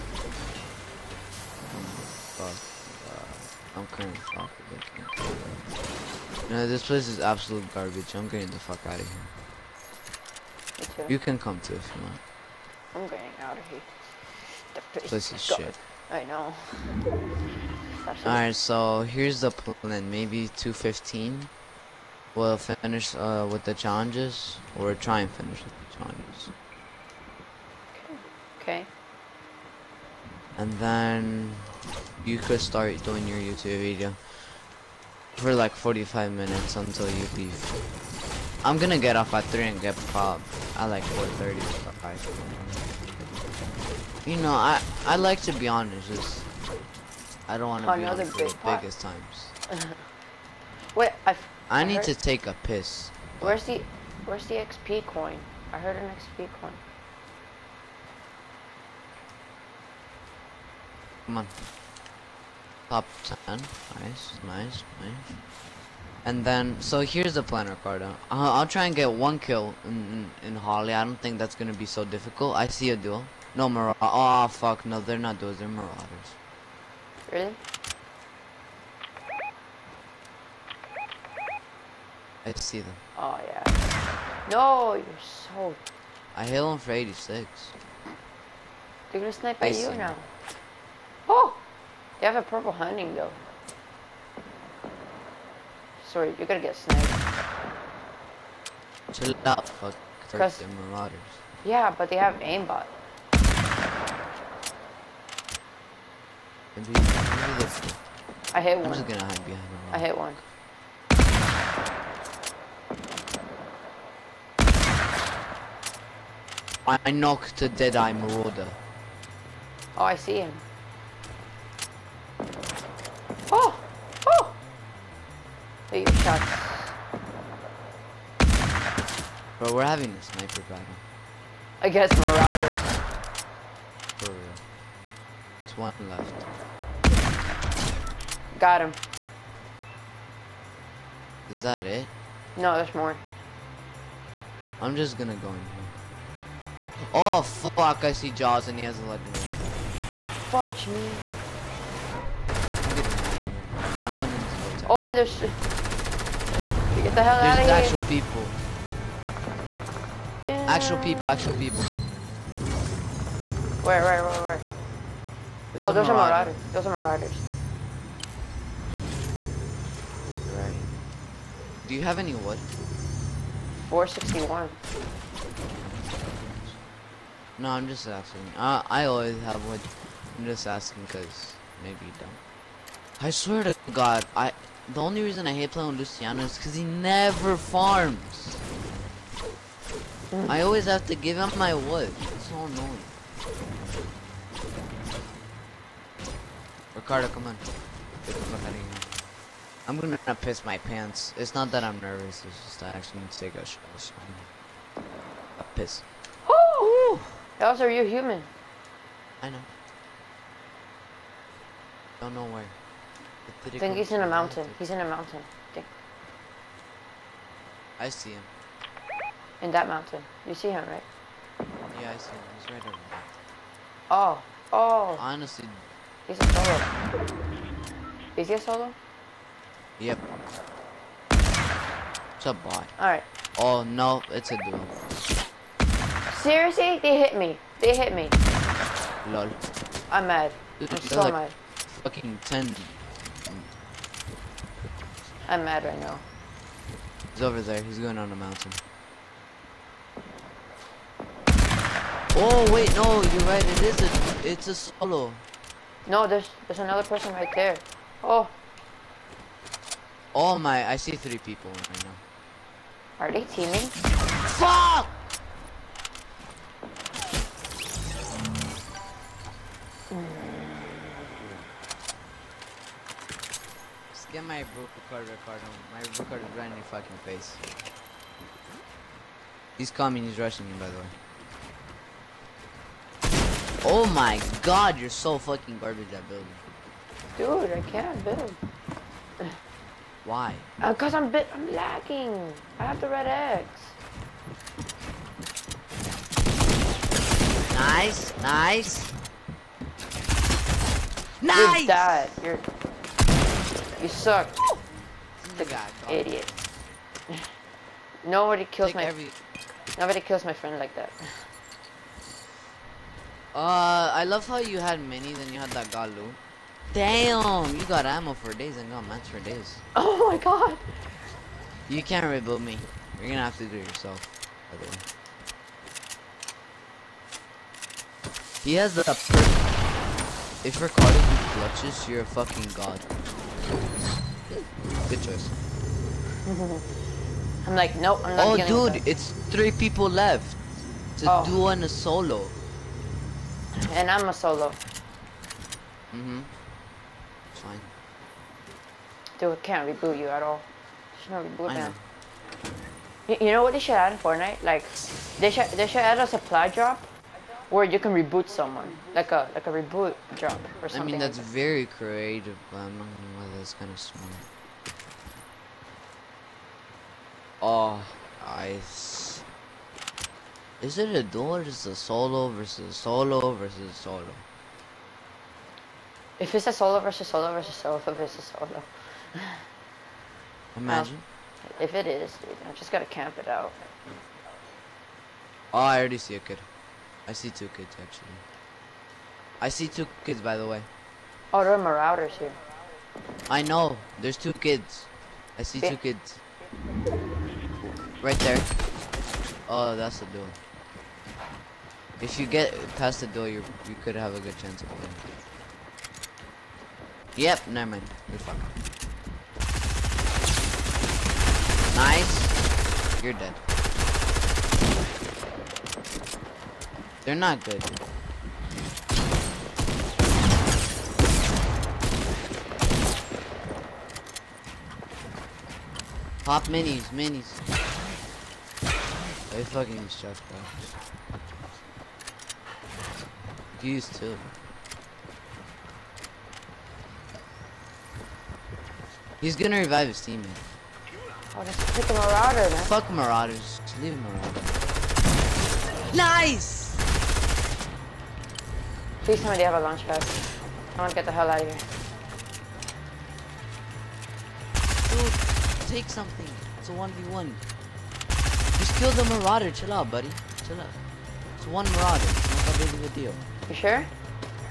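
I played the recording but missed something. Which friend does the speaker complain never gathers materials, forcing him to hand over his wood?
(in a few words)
Luciano.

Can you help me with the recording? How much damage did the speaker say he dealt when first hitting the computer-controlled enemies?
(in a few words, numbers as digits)
86.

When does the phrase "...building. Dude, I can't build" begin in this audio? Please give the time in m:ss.
4:46.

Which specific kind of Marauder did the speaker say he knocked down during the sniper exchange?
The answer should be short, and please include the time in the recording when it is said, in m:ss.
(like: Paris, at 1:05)
Deadeye Marauder, at 1:57.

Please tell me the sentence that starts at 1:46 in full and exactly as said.
Maybe, maybe I hit I'm one.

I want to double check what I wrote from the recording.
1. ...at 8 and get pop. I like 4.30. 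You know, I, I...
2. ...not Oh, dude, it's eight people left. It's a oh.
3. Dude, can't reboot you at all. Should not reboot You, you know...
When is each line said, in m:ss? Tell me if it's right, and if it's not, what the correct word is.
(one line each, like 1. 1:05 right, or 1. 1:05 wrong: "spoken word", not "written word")
1. 0:39 wrong: "3", not "8"
2. 5:38 wrong: "three", not "eight"
3. 5:49 right.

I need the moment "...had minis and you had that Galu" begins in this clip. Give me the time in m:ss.
5:14.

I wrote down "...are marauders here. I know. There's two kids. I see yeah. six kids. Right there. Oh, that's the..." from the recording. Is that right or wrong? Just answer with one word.
wrong.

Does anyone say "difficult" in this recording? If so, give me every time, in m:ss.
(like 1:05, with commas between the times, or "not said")
1:12.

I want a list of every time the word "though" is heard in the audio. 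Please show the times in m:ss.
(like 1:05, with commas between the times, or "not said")
1:33, 7:10.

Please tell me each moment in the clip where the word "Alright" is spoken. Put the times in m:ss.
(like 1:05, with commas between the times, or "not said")
0:18, 3:52.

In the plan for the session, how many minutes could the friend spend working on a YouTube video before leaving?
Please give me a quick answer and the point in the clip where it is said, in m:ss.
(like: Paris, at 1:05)
45, at 0:35.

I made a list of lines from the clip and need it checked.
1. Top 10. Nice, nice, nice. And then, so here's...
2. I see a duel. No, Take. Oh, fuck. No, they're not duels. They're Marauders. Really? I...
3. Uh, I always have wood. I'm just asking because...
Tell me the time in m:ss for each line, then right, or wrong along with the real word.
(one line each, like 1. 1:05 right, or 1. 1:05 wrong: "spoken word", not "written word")
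1. 1:02 right
2. 1:12 wrong: "Marauders", not "Take"
3. 2:58 right.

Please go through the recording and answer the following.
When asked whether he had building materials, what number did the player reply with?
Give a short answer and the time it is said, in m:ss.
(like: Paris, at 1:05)
461, at 2:53.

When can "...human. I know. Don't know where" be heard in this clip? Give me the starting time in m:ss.
3:28.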